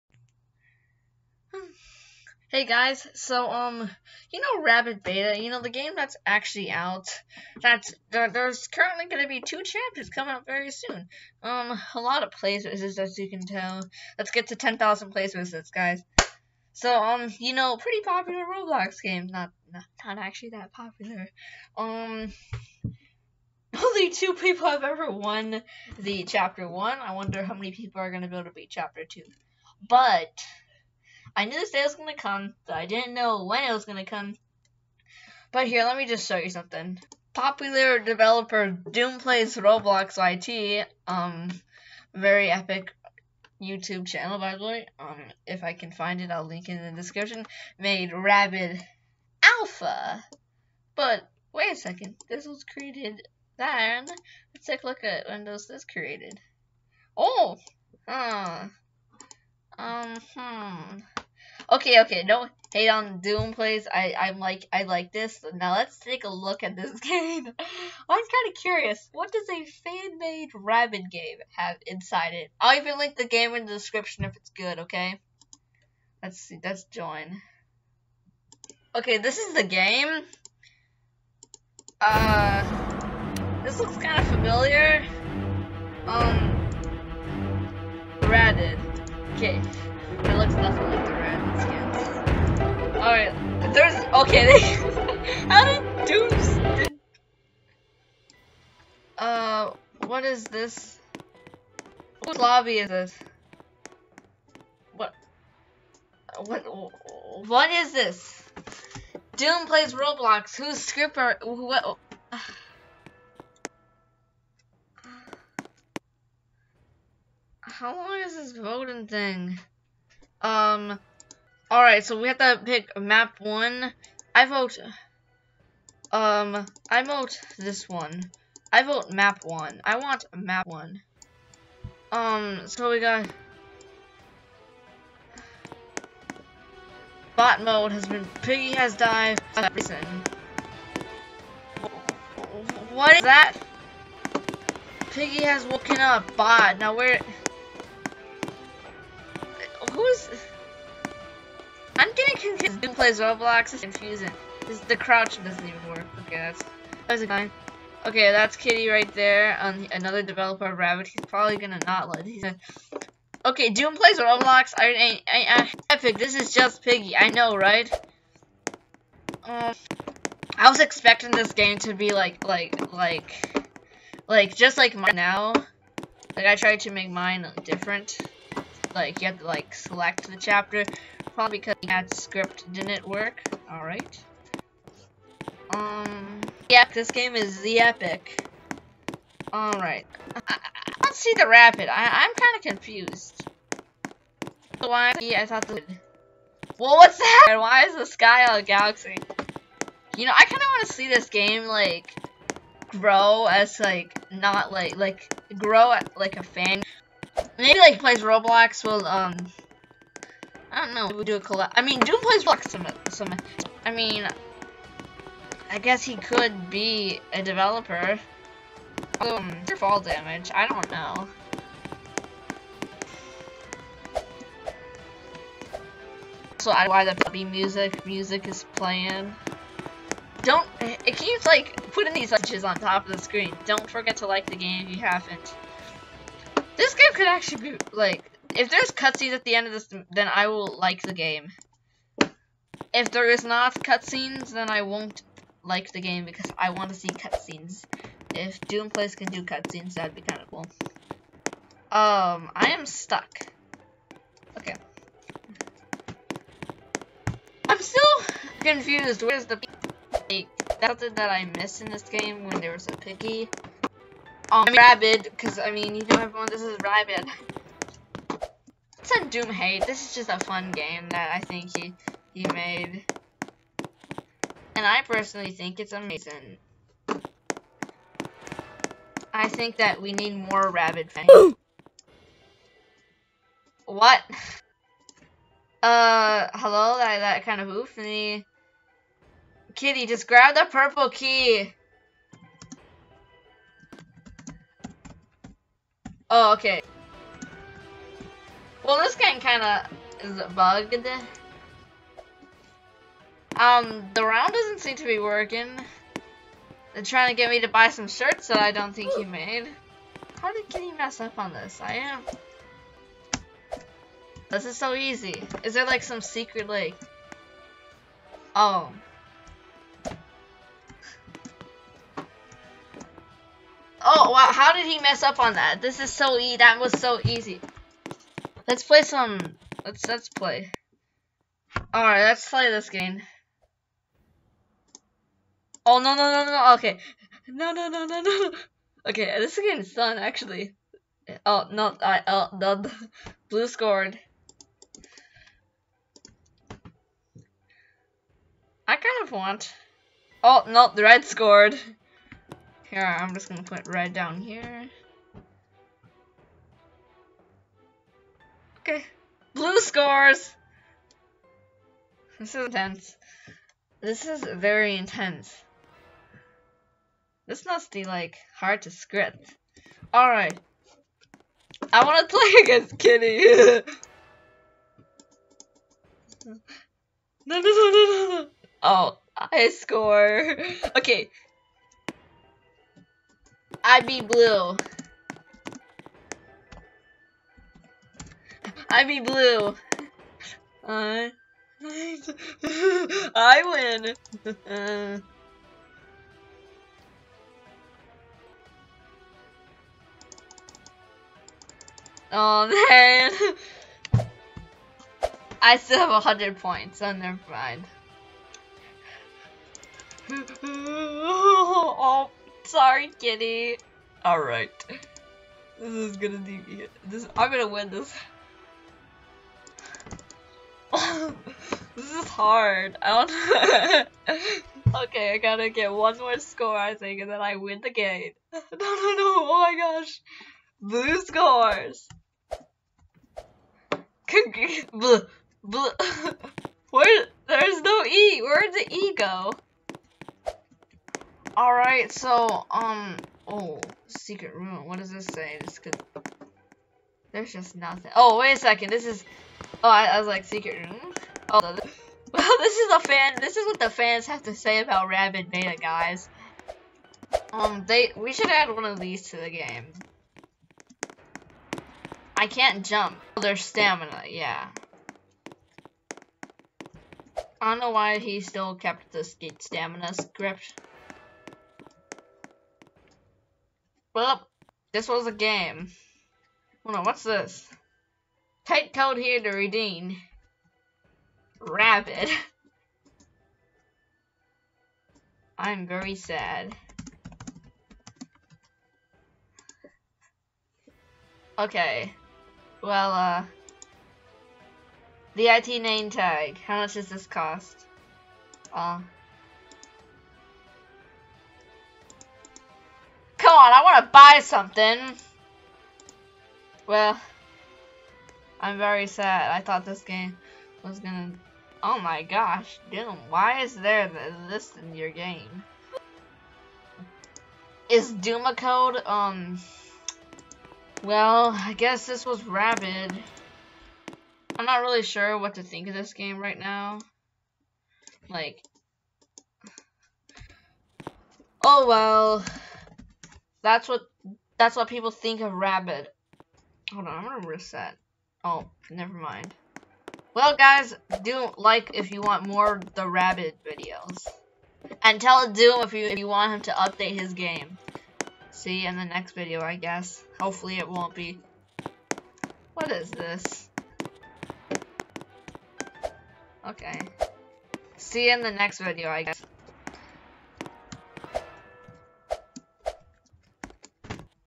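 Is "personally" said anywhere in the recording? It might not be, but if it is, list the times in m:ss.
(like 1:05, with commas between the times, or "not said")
4:35.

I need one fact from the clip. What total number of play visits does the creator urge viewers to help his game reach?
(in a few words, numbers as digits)
10,000.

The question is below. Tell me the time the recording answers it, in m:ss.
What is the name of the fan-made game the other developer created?
0:48.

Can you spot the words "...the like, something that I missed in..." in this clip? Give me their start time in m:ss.
4:19.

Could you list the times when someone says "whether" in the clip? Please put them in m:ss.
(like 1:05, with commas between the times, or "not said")
not said.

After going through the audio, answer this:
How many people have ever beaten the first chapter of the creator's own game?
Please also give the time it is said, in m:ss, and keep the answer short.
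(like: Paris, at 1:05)
2, at 0:23.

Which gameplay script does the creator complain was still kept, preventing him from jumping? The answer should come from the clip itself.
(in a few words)
Stamina script.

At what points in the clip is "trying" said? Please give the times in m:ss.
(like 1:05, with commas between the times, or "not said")
5:07.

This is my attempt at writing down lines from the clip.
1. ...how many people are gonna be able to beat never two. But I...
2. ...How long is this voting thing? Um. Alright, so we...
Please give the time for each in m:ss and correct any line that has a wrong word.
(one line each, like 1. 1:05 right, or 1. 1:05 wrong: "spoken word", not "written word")
1. 0:27 wrong: "chapter", not "never"
2. 1:57 right.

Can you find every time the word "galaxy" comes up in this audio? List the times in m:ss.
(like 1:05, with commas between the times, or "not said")
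3:18.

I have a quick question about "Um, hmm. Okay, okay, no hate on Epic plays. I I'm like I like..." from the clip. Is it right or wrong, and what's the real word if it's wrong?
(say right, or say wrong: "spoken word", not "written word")
wrong: "Doom", not "Epic".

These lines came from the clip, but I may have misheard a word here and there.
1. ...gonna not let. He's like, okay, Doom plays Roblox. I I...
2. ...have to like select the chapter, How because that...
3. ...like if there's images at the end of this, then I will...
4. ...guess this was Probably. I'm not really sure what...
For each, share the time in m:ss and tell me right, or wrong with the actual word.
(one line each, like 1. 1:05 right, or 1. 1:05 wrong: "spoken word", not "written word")
1. 2:41 right
2. 2:59 wrong: "Probably", not "How"
3. 3:57 wrong: "cutscenes", not "images"
4. 8:41 wrong: "Rabbid", not "Probably".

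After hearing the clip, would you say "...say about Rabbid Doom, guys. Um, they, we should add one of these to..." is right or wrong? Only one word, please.
wrong.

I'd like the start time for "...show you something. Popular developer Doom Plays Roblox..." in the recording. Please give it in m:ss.
0:36.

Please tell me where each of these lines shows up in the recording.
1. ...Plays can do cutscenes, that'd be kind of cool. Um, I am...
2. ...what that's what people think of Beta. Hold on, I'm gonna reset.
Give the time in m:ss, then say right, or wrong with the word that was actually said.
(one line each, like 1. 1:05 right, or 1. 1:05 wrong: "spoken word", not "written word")
1. 4:08 right
2. 8:53 wrong: "Rabbid", not "Beta".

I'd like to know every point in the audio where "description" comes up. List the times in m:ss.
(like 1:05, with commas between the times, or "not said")
0:47, 1:13.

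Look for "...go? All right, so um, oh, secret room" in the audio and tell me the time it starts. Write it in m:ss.
7:19.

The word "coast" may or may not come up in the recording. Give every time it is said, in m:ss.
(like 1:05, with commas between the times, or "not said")
not said.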